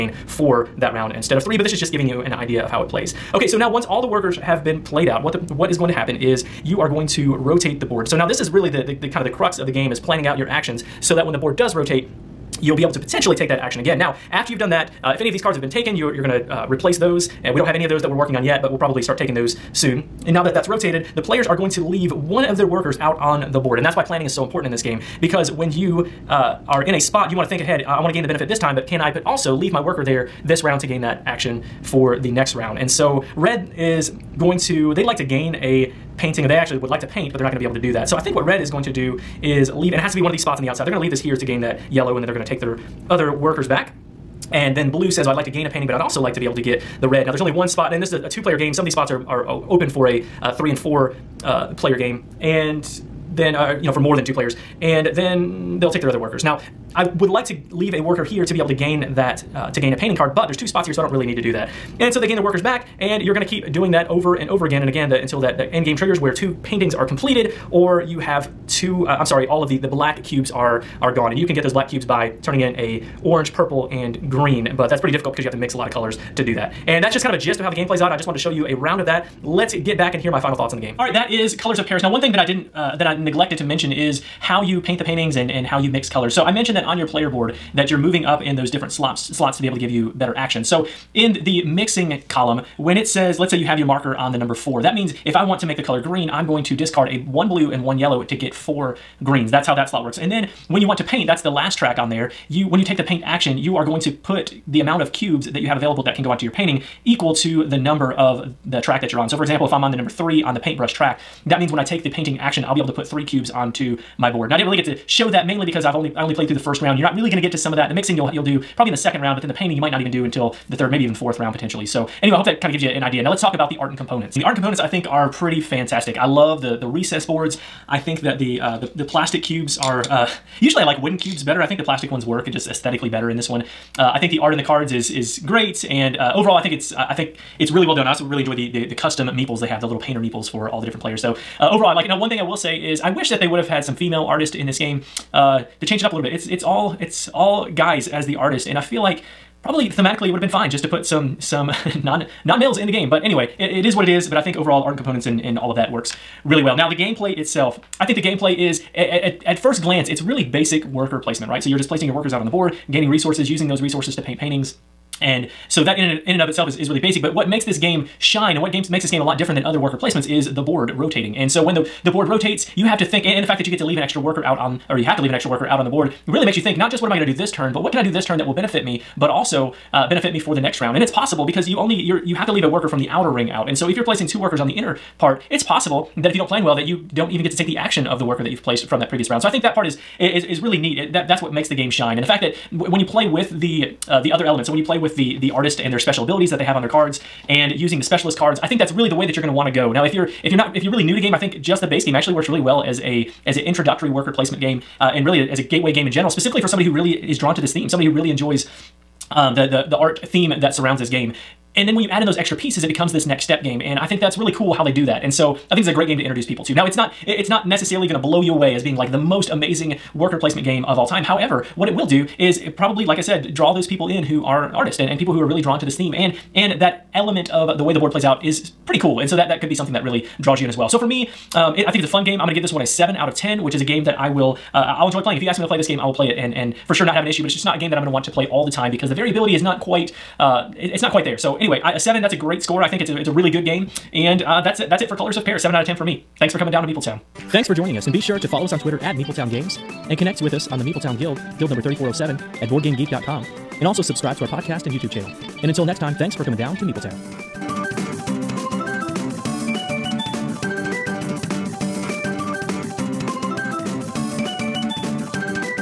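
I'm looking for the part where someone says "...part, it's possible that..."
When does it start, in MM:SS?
03:05.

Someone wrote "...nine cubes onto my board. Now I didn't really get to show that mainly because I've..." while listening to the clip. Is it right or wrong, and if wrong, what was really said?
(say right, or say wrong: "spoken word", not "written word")
wrong: "three", not "nine".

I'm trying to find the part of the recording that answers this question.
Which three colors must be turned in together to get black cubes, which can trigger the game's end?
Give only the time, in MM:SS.
01:13.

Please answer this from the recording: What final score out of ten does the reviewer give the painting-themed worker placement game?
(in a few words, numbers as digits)
7.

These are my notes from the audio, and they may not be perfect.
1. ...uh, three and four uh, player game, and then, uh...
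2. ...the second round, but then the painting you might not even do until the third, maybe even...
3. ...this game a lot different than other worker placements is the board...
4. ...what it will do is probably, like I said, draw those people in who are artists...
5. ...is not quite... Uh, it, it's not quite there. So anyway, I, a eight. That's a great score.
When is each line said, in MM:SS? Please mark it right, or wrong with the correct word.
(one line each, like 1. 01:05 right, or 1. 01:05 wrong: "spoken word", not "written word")
1. 00:50 right
2. 01:58 right
3. 02:49 right
4. 03:41 right
5. 03:59 wrong: "seven", not "eight".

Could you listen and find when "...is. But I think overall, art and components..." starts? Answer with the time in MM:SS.
02:34.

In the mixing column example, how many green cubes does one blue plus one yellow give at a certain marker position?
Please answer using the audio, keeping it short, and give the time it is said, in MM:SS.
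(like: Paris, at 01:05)
4, at 01:38.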